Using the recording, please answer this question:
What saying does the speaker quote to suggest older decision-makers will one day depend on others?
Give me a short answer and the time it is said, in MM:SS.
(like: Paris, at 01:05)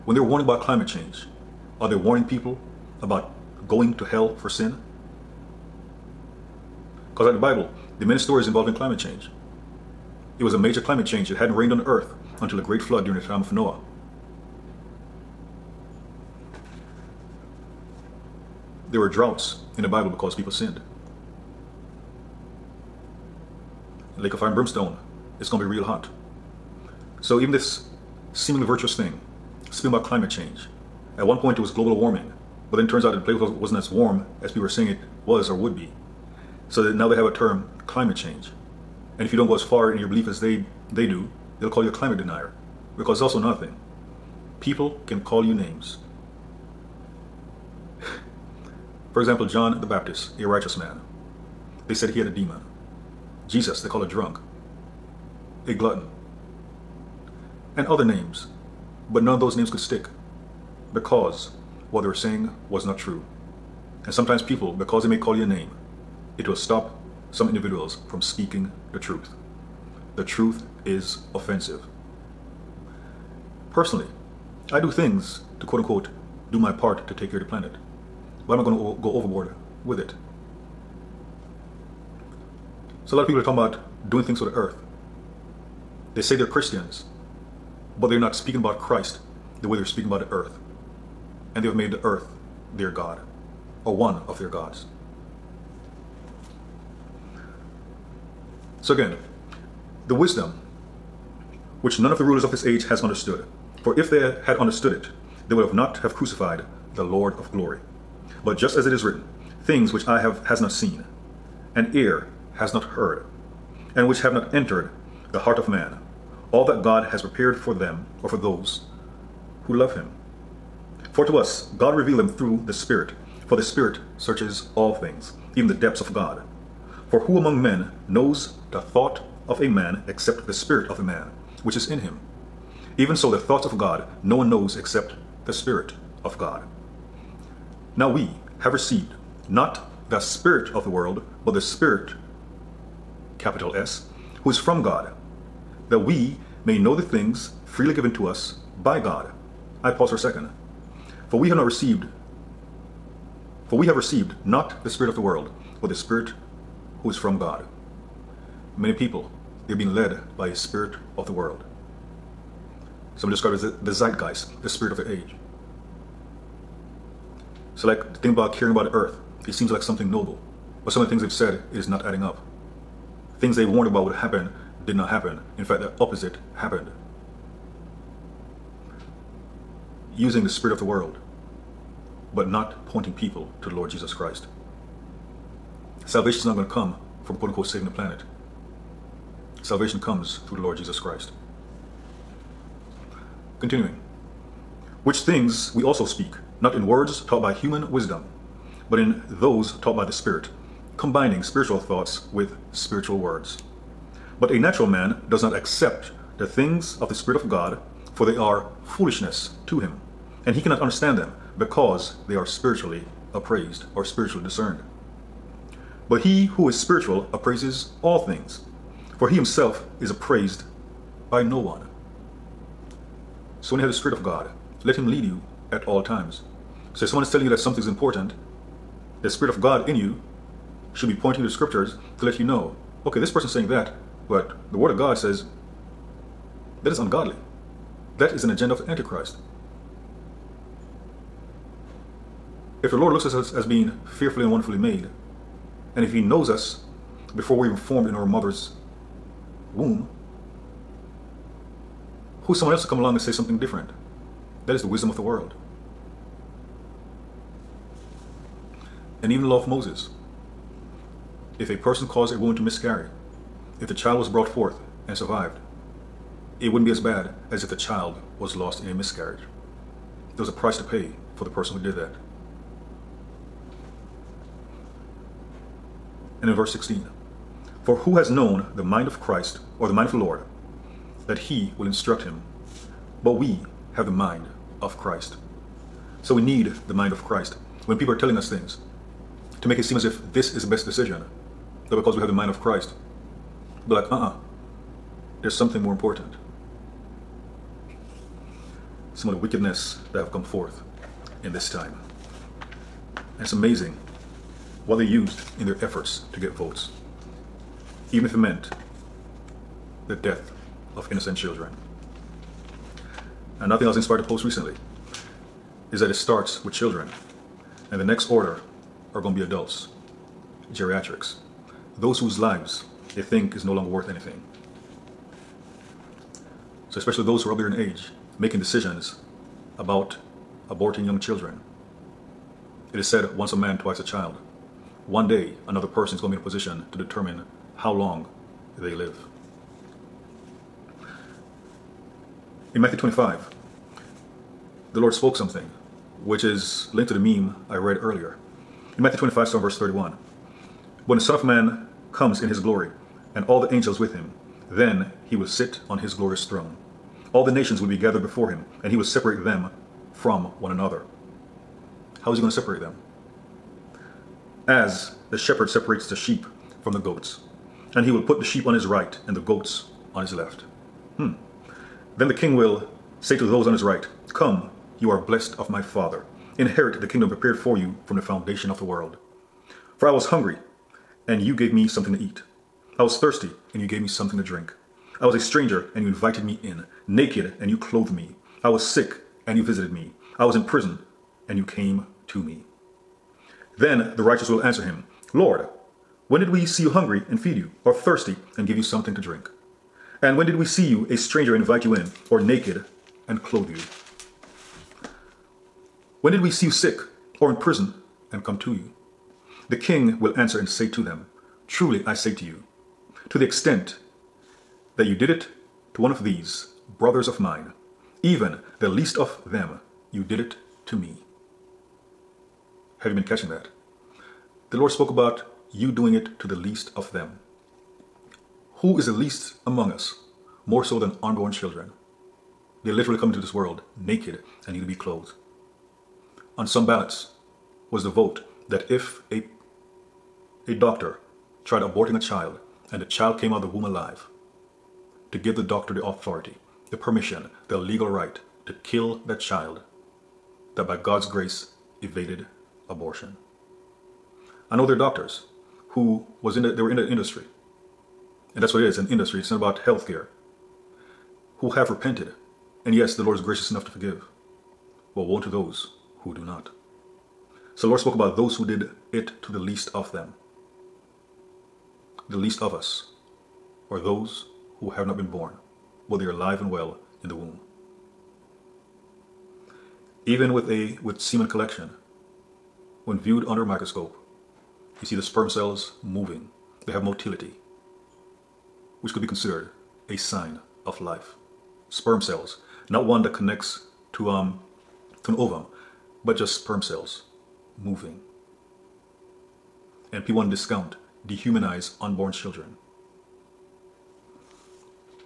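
once a man, twice a child, at 05:33.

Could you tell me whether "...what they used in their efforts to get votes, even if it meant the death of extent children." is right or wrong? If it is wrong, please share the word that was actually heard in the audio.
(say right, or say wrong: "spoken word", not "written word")
wrong: "innocent", not "extent".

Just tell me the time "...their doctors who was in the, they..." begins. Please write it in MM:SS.
07:34.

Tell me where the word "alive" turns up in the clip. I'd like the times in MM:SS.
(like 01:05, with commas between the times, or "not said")
07:23, 07:56.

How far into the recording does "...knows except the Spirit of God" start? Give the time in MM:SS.
02:14.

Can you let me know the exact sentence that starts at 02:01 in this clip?
For to us, God revealed him through the Spirit, for the Spirit searches all things, even the depths of God.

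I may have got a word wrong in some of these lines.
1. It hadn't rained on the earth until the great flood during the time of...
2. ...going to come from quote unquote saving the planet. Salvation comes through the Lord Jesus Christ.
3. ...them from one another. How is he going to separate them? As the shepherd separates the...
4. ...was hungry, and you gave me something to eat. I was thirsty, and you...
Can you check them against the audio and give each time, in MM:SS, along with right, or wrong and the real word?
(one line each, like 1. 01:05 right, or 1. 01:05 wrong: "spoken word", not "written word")
1. 00:11 right
2. 03:06 right
3. 05:59 right
4. 06:20 right.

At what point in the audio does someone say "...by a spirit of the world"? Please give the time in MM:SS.
02:40.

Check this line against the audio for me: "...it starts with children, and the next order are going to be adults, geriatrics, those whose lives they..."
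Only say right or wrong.
right.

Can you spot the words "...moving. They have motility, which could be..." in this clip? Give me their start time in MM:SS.
08:06.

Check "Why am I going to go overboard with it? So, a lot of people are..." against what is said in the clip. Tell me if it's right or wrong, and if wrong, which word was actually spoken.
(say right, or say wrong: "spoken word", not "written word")
right.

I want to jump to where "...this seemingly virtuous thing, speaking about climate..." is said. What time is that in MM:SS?
00:27.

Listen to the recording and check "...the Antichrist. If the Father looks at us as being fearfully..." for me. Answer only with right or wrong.
wrong.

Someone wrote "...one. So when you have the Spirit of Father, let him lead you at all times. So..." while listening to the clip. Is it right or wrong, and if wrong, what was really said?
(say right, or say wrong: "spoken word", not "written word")
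wrong: "God", not "Father".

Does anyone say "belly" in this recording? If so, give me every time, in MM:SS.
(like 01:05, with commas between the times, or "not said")
not said.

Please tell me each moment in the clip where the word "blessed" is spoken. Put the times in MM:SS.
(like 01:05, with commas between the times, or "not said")
06:15.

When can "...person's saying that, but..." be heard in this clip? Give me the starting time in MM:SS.
03:53.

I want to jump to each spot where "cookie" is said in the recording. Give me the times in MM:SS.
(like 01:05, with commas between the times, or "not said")
not said.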